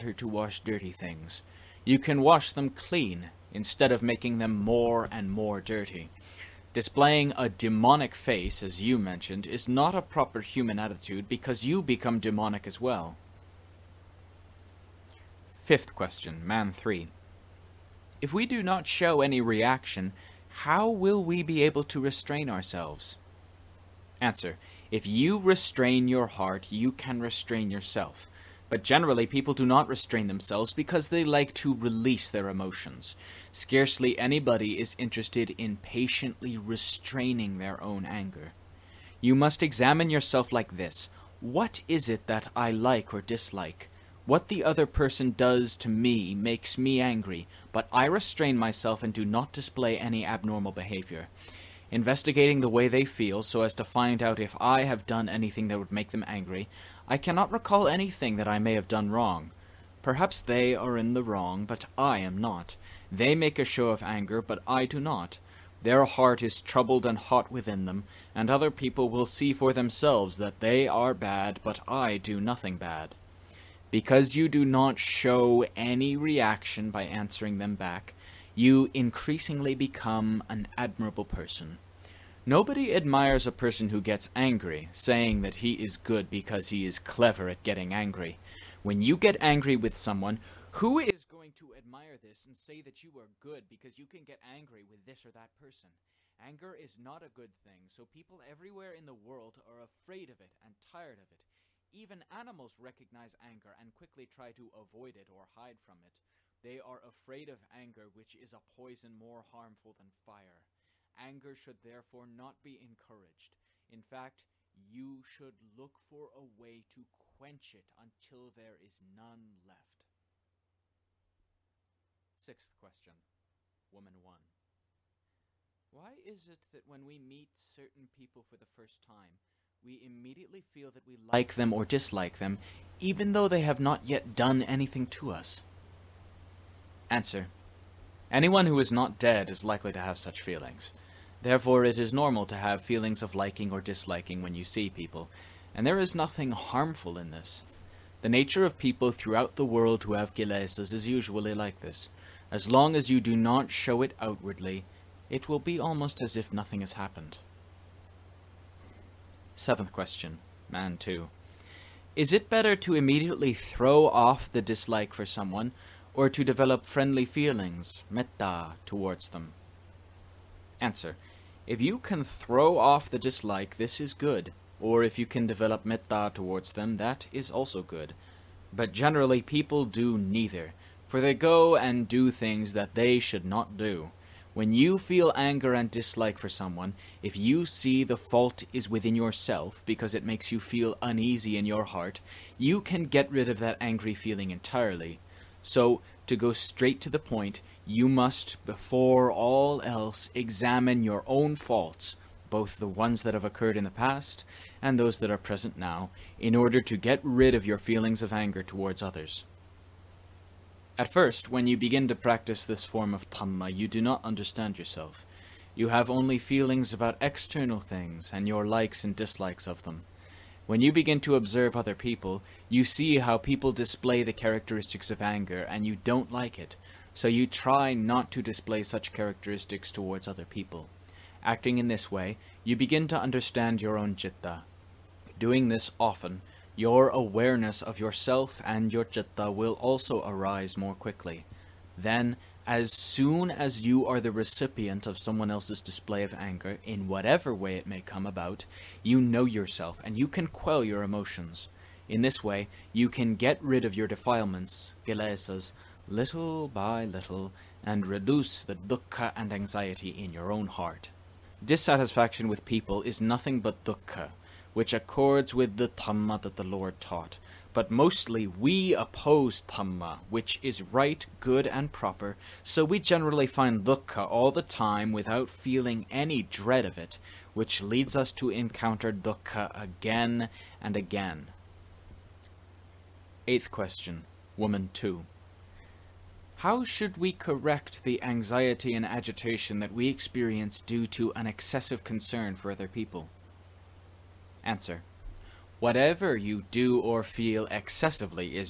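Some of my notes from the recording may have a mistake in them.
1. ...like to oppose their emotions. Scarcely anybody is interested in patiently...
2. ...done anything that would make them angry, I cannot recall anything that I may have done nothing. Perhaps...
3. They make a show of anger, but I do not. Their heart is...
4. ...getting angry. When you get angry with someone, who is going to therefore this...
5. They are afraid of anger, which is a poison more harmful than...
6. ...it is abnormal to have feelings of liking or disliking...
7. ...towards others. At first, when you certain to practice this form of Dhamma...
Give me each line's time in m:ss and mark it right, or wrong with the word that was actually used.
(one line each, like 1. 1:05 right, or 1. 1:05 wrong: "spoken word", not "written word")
1. 0:31 wrong: "release", not "oppose"
2. 0:55 wrong: "wrong", not "nothing"
3. 1:03 right
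4. 1:27 wrong: "admire", not "therefore"
5. 1:46 right
6. 2:21 wrong: "normal", not "abnormal"
7. 3:28 wrong: "begin", not "certain".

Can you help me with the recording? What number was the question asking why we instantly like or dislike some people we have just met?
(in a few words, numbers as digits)
6.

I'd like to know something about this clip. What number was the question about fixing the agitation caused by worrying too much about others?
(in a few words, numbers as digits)
8.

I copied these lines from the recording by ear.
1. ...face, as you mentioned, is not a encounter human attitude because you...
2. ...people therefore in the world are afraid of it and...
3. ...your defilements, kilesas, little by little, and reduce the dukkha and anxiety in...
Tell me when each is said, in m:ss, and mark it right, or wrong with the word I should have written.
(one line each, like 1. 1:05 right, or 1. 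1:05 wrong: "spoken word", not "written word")
1. 0:08 wrong: "proper", not "encounter"
2. 1:38 wrong: "everywhere", not "therefore"
3. 4:13 right.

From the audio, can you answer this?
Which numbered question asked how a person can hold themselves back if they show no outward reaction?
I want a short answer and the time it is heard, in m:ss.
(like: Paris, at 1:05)
5, at 0:15.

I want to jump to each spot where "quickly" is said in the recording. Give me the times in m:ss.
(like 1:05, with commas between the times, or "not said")
1:43, 4:00.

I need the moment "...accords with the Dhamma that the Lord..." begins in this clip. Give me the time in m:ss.
4:24.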